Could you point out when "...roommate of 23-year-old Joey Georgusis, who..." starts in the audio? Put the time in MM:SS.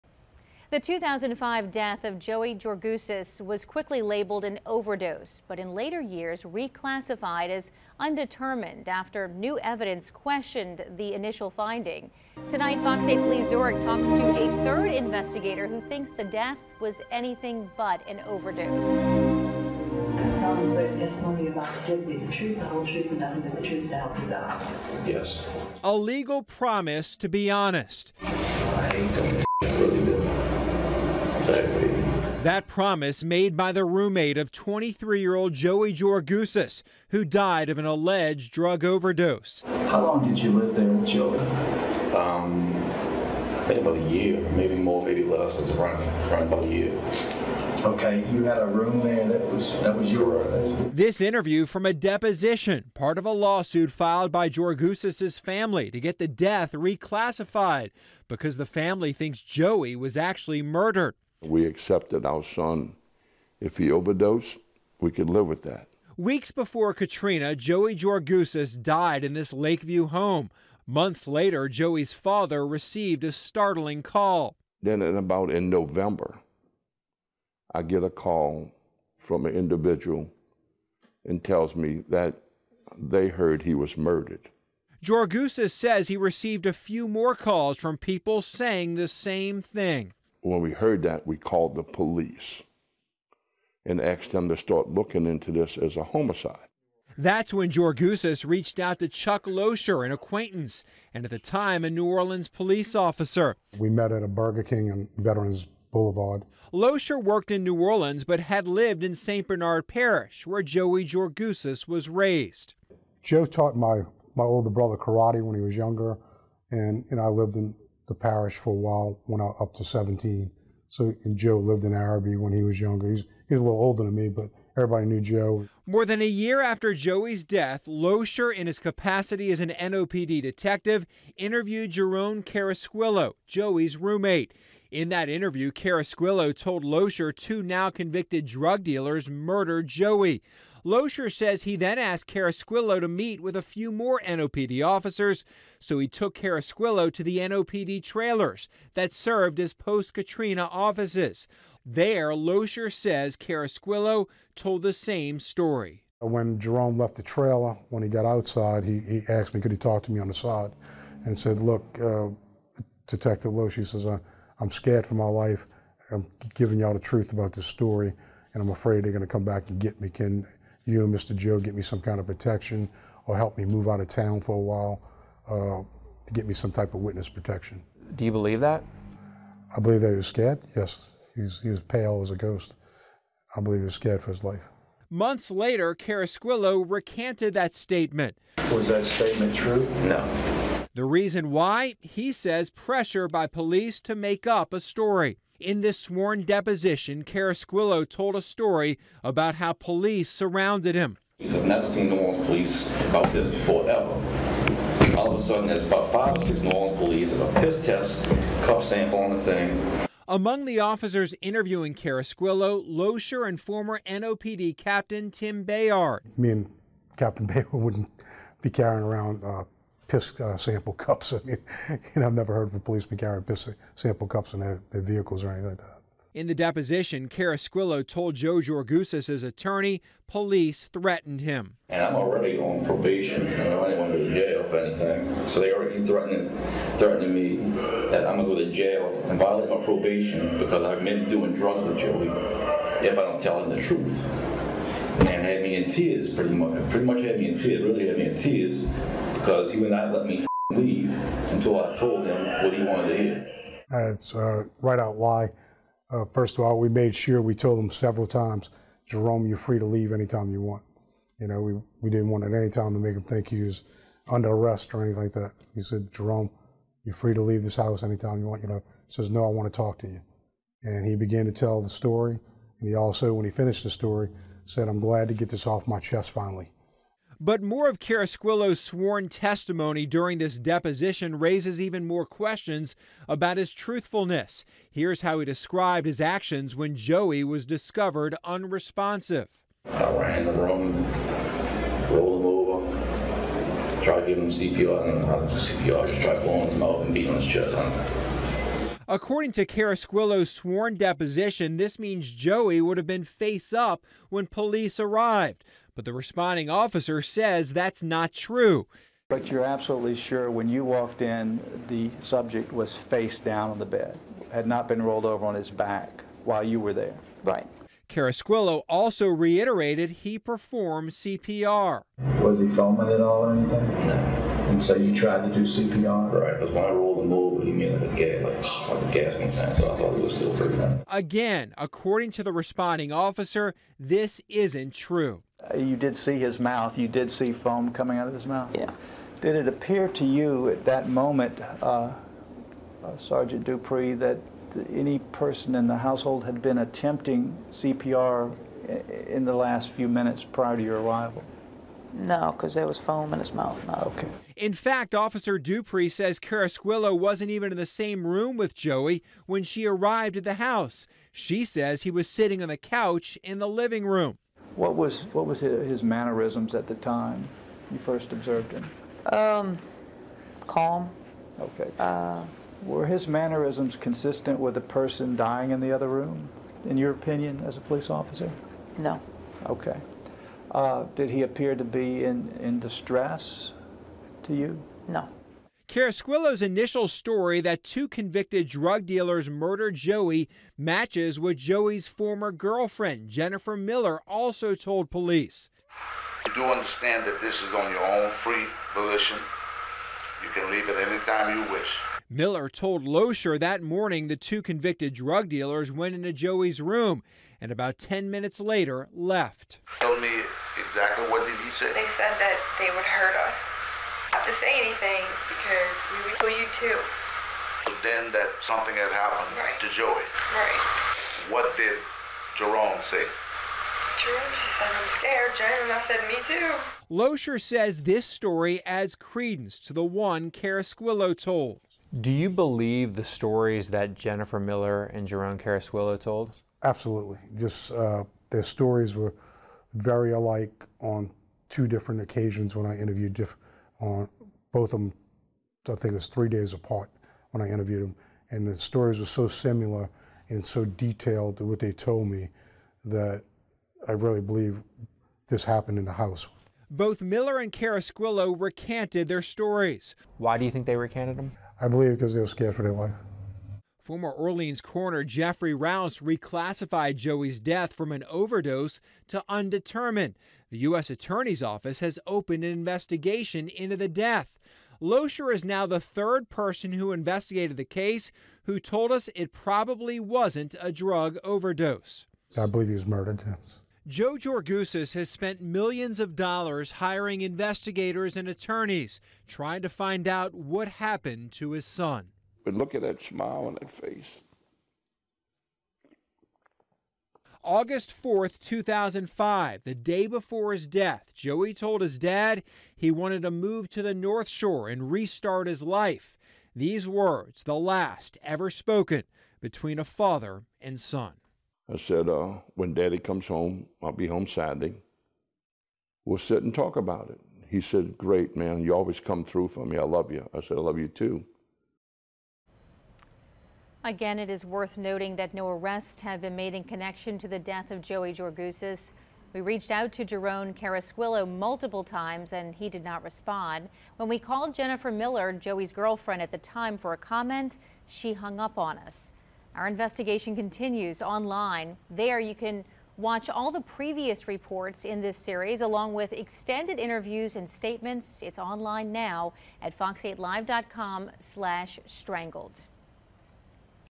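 00:33.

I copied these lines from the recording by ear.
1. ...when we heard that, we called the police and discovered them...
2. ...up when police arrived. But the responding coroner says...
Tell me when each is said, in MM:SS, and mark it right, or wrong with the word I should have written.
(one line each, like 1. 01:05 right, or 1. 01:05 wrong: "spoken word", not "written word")
1. 01:30 wrong: "asked", not "discovered"
2. 05:03 wrong: "officer", not "coroner".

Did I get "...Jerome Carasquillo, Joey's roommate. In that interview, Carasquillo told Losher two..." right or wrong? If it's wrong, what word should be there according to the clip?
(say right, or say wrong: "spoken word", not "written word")
right.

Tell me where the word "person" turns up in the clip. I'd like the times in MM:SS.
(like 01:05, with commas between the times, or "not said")
05:45, 06:14, 07:56.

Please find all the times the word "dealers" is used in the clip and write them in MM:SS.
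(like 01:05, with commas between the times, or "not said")
02:18, 06:29, 06:45.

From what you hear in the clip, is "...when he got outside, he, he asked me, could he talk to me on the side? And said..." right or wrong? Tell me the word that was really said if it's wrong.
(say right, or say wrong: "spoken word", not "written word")
right.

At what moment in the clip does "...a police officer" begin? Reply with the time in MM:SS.
06:17.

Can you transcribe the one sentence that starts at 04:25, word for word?
He said, Jerome, you're free to leave this house anytime you want.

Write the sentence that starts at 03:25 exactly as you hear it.
All of a sudden, there's about five or six New Orleans police.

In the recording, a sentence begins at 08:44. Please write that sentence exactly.
Again, it is worth noting that no arrests have been made in connection to the death of Joey Georgusis.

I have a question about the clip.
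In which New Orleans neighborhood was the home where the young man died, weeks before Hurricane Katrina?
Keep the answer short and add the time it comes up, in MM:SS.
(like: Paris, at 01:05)
Lakeview, at 01:09.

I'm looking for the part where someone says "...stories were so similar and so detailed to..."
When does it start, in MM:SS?
07:28.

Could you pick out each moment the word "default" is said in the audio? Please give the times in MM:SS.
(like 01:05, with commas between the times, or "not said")
not said.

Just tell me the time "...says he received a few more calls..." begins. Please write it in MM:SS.
01:25.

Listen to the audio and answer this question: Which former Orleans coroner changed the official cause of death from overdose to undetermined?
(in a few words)
Jeffrey Rouse.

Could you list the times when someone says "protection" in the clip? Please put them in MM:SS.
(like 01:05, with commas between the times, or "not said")
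02:52, 02:57.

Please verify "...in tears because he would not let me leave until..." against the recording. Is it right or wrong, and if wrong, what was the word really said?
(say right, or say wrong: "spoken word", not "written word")
right.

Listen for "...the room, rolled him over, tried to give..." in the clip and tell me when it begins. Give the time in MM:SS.
04:50.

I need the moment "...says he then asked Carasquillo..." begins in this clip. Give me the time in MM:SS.
02:21.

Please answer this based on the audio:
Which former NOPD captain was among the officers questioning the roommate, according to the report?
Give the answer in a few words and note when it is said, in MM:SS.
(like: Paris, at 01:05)
Tim Bayard, at 03:35.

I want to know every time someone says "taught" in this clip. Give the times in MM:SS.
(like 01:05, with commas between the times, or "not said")
01:53.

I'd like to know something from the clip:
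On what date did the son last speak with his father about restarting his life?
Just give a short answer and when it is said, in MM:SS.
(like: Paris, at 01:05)
August 4th, 2005, at 08:17.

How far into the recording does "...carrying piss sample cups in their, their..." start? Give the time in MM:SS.
03:43.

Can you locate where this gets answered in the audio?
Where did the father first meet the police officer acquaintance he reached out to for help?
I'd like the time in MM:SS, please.
01:44.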